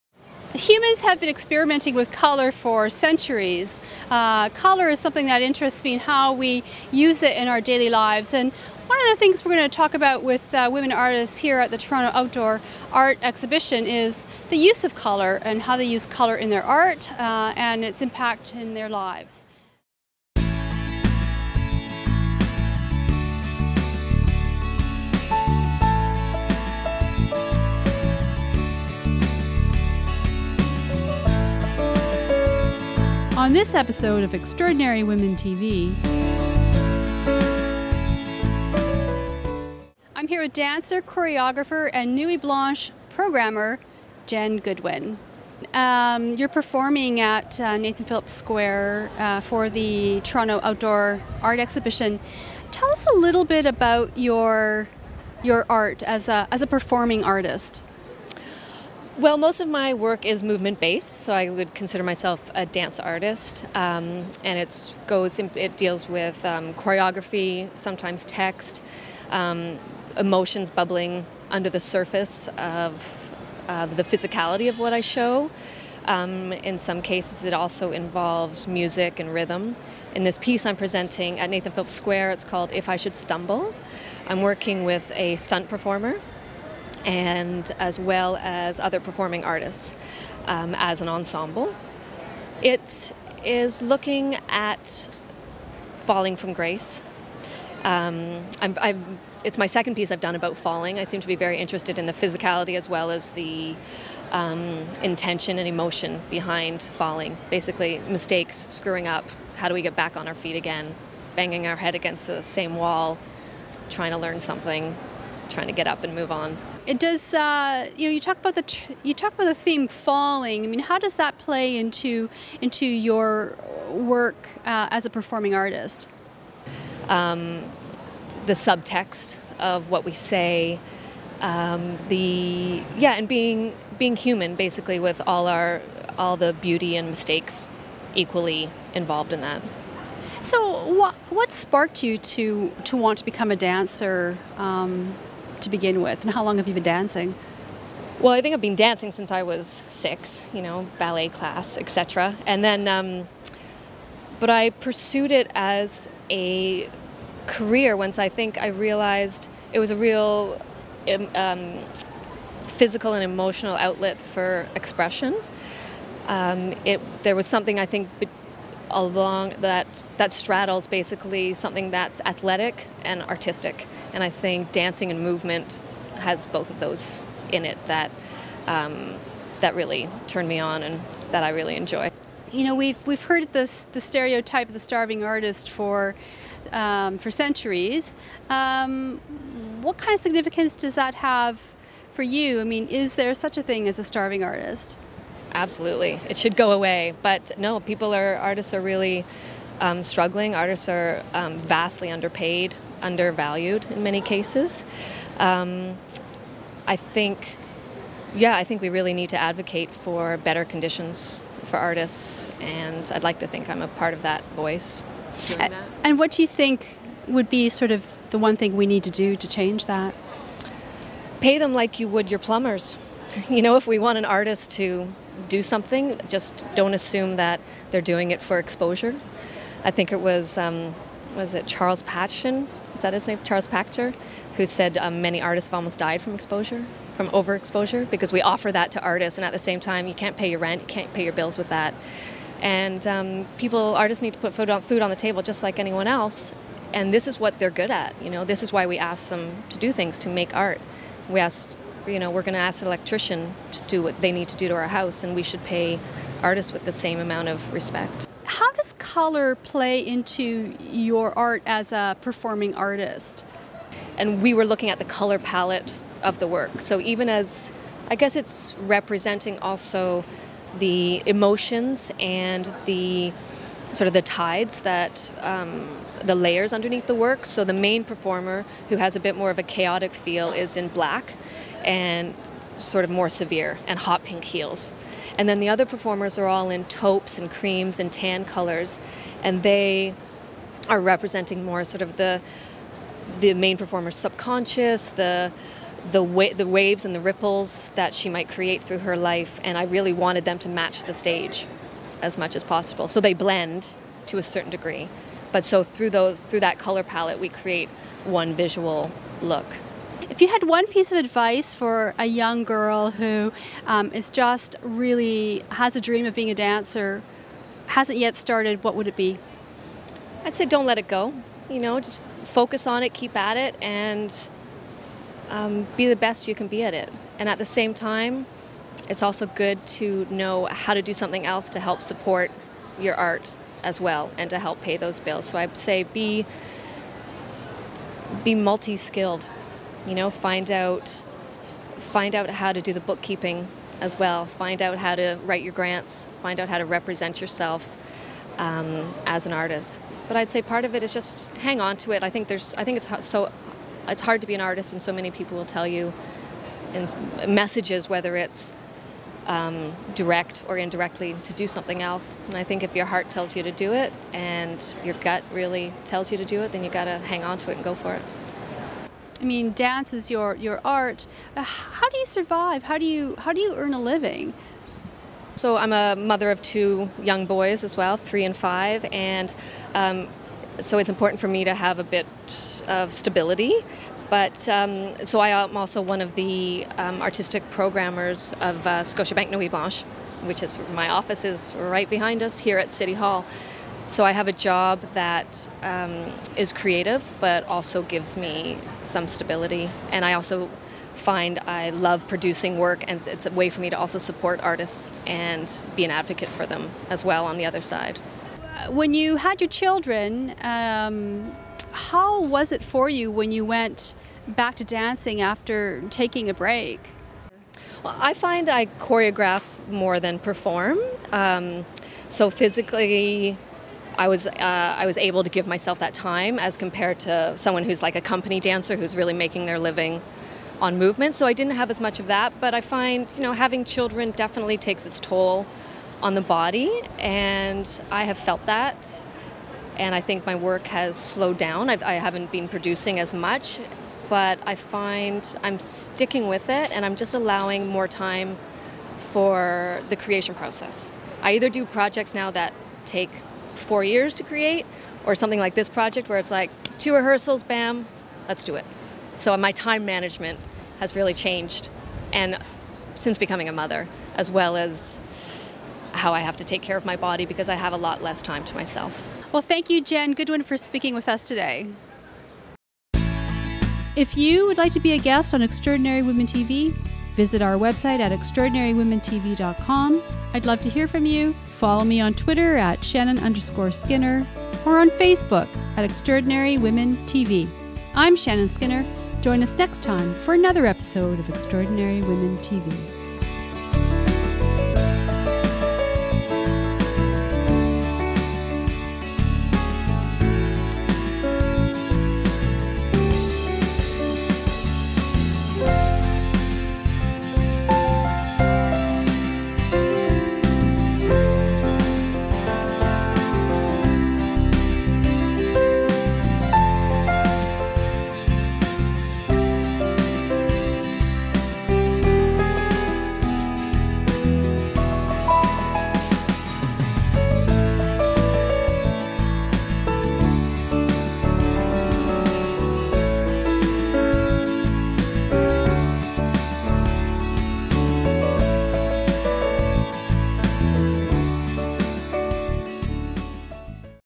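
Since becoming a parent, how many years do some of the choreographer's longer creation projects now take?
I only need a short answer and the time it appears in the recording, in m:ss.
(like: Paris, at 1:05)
4, at 7:33.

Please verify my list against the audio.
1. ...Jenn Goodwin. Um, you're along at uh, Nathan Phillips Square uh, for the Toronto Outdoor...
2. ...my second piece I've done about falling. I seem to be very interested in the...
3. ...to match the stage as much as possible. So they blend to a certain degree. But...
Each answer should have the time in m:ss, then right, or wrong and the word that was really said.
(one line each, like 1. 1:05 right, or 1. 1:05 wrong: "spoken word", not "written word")
1. 0:44 wrong: "performing", not "along"
2. 1:39 right
3. 5:00 right.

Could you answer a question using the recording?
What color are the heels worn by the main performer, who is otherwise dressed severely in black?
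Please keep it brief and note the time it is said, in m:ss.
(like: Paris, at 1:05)
Hot pink, at 4:43.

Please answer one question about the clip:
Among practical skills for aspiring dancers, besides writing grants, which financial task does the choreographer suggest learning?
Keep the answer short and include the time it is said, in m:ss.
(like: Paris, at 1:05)
Bookkeeping, at 5:42.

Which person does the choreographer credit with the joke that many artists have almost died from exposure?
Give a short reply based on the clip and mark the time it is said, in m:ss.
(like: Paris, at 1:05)
Charles Pachter, at 3:53.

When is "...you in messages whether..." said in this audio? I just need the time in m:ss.
5:55.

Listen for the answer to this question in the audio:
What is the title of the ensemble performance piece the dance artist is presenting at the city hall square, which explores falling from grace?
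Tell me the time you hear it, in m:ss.
1:22.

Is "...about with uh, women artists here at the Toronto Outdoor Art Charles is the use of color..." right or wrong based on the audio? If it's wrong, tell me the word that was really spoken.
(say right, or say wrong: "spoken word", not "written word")
wrong: "Exhibition", not "Charles".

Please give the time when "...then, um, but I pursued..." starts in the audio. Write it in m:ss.
2:32.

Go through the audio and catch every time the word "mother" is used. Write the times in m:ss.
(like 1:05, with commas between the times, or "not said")
6:16, 7:43.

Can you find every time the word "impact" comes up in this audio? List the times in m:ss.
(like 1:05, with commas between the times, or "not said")
0:18.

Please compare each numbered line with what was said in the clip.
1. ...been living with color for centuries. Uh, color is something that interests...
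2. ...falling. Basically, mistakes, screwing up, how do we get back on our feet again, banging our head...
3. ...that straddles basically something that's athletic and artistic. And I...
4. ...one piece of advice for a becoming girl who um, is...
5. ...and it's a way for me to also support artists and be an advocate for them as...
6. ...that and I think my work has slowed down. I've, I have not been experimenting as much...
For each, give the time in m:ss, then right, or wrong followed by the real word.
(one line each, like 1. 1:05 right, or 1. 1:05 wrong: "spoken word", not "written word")
1. 0:01 wrong: "experimenting", not "living"
2. 1:46 right
3. 2:50 right
4. 5:10 wrong: "young", not "becoming"
5. 6:43 right
6. 7:18 wrong: "producing", not "experimenting".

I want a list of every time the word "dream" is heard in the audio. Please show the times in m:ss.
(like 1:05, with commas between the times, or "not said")
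5:16.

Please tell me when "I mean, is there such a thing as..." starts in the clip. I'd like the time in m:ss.
3:12.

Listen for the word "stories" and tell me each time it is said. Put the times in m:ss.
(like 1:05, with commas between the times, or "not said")
not said.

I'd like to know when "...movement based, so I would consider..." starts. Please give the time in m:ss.
1:00.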